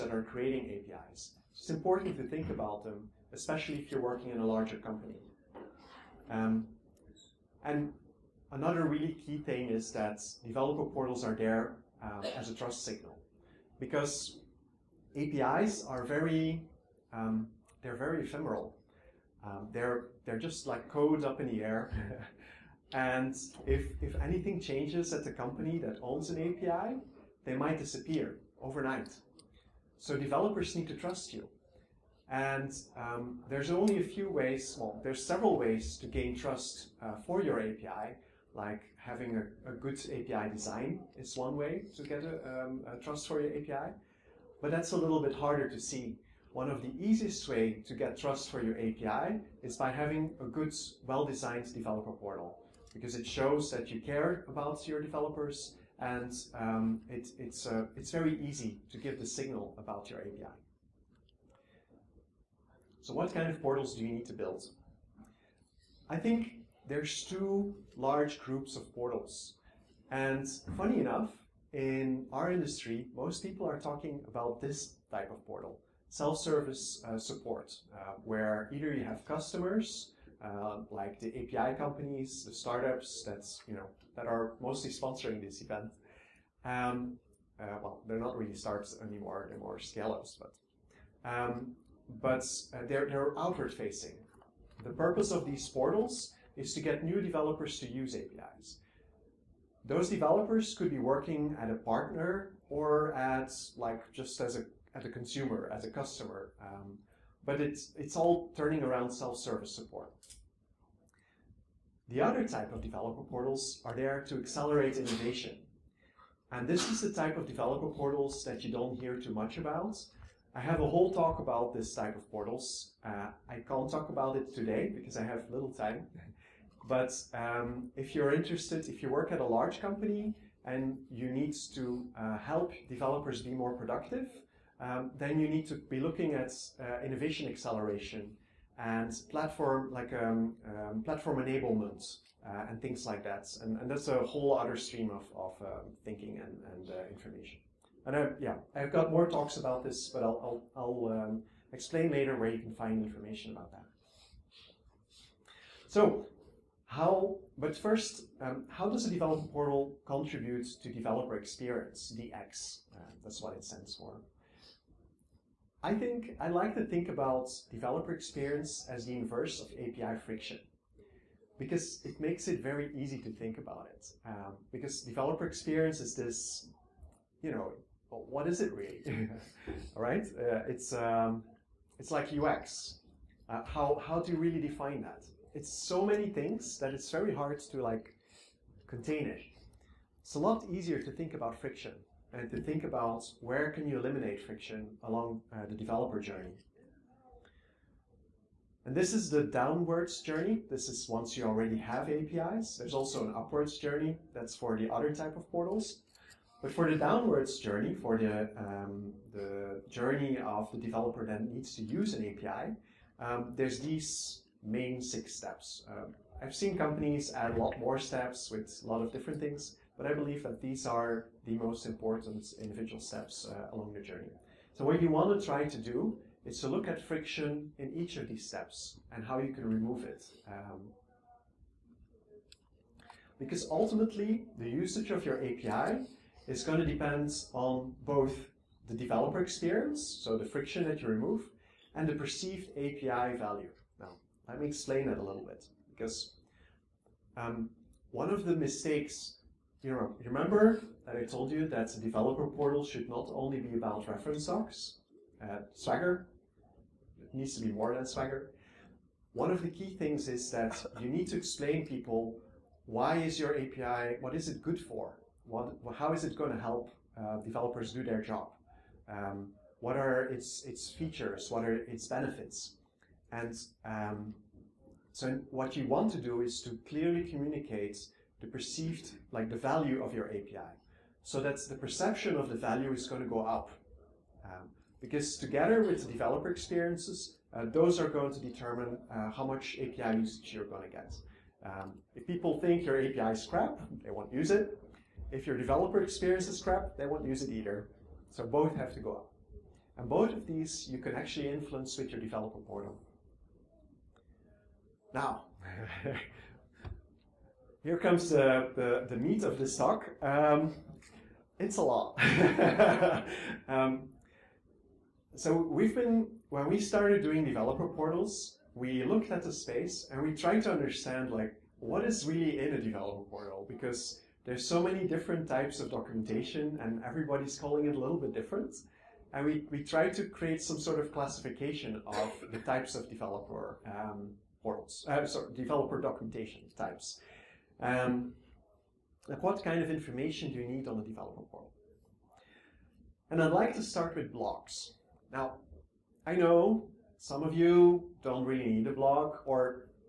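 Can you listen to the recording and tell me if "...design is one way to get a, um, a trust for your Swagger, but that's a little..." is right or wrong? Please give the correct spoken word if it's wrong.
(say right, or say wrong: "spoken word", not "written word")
wrong: "API", not "Swagger".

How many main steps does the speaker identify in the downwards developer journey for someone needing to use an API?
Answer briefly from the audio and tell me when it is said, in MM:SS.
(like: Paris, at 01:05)
6, at 03:35.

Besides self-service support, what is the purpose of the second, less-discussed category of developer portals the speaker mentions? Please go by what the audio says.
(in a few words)
Accelerate innovation.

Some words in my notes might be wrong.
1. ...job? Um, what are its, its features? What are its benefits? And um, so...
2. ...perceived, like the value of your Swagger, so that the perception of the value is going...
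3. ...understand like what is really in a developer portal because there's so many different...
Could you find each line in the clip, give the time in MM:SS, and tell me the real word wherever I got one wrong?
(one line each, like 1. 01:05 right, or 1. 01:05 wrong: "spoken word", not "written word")
1. 04:28 right
2. 04:38 wrong: "API", not "Swagger"
3. 05:20 right.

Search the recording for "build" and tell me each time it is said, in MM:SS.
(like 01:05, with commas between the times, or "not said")
01:04.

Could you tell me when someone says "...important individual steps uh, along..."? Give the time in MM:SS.
03:41.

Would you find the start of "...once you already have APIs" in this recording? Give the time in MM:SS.
03:21.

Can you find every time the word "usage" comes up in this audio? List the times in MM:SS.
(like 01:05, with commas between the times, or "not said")
03:54, 04:50.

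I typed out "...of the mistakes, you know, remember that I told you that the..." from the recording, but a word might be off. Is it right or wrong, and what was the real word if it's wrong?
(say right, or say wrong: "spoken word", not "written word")
right.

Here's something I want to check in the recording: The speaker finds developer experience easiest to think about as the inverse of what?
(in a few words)
API friction.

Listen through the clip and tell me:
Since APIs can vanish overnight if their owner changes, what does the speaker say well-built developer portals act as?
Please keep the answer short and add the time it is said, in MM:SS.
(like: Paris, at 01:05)
A trust signal, at 00:12.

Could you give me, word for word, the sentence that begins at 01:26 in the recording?
Um, uh, well, they're not really startups anymore, they're more scale-ups, but, um, but uh, they're, they're outward facing.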